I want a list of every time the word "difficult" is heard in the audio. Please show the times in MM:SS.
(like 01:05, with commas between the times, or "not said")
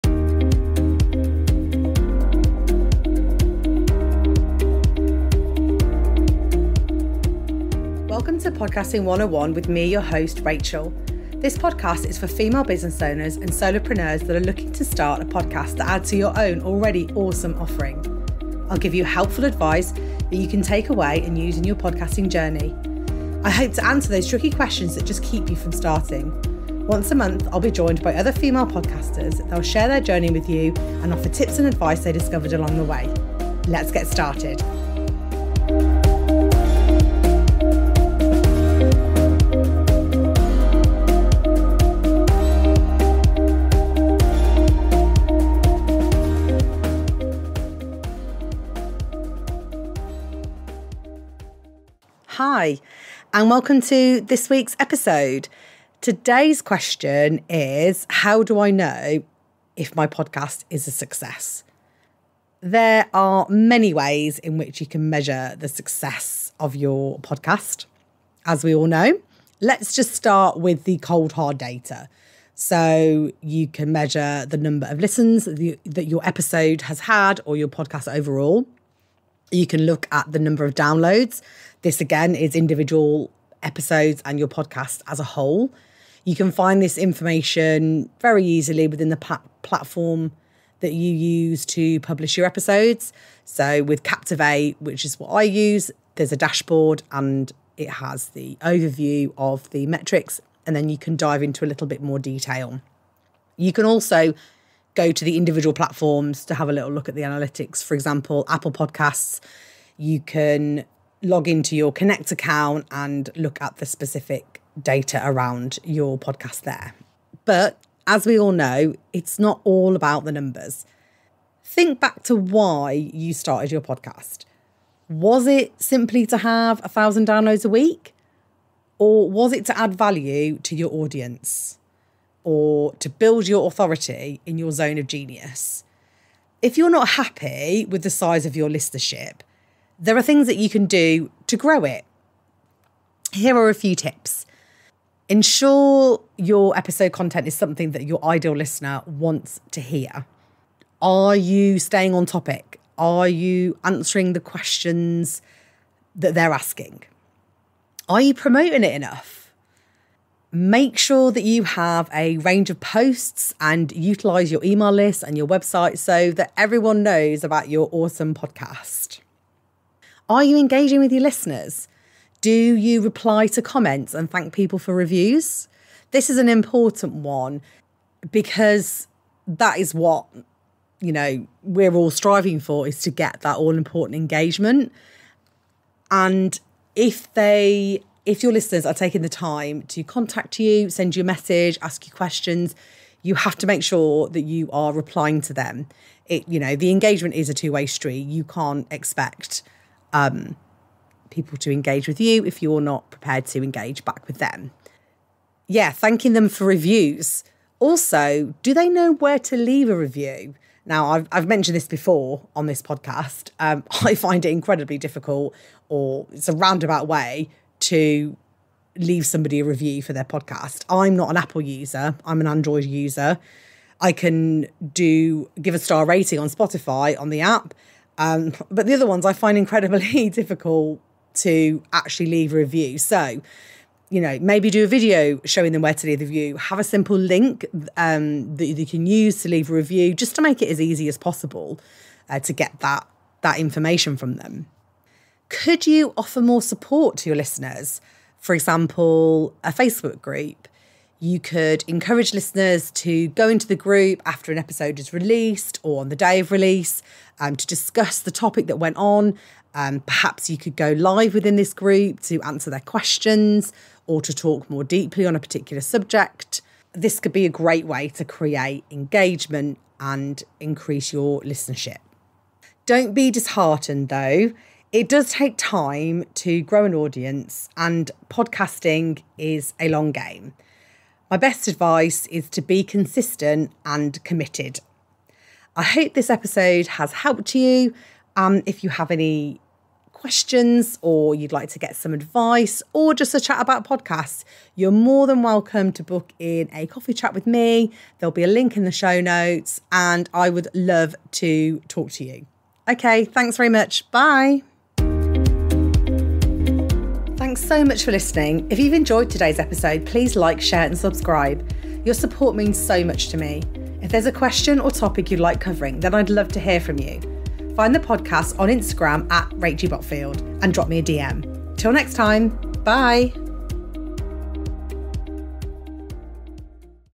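03:34, 03:50.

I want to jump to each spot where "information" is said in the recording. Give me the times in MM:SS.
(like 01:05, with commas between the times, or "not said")
01:26, 04:03.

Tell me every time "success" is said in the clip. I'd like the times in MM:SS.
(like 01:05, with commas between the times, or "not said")
01:00, 01:05.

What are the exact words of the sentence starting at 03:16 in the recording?
It, you know, the engagement is a two-way street.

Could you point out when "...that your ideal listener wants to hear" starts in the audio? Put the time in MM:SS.
02:27.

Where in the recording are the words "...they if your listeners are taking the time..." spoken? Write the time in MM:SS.
03:07.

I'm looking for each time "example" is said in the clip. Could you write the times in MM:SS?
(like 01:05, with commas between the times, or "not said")
01:47, 04:08.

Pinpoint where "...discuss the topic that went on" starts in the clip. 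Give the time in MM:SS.
04:17.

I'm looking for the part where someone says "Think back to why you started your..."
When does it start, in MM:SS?
02:01.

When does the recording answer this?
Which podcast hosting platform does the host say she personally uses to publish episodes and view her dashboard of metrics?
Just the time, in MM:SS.
01:34.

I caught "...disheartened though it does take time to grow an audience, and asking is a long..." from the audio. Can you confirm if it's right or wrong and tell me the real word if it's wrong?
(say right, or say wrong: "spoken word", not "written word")
wrong: "podcasting", not "asking".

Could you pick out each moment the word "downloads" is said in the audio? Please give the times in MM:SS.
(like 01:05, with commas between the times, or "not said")
01:20, 02:07.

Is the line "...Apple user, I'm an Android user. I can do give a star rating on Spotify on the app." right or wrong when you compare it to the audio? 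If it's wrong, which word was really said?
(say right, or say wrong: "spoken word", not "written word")
right.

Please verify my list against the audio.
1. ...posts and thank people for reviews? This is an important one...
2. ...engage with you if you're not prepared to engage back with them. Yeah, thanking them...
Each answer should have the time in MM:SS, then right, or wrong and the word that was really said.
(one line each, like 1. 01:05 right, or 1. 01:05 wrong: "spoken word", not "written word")
1. 02:53 wrong: "comments", not "posts"
2. 03:21 right.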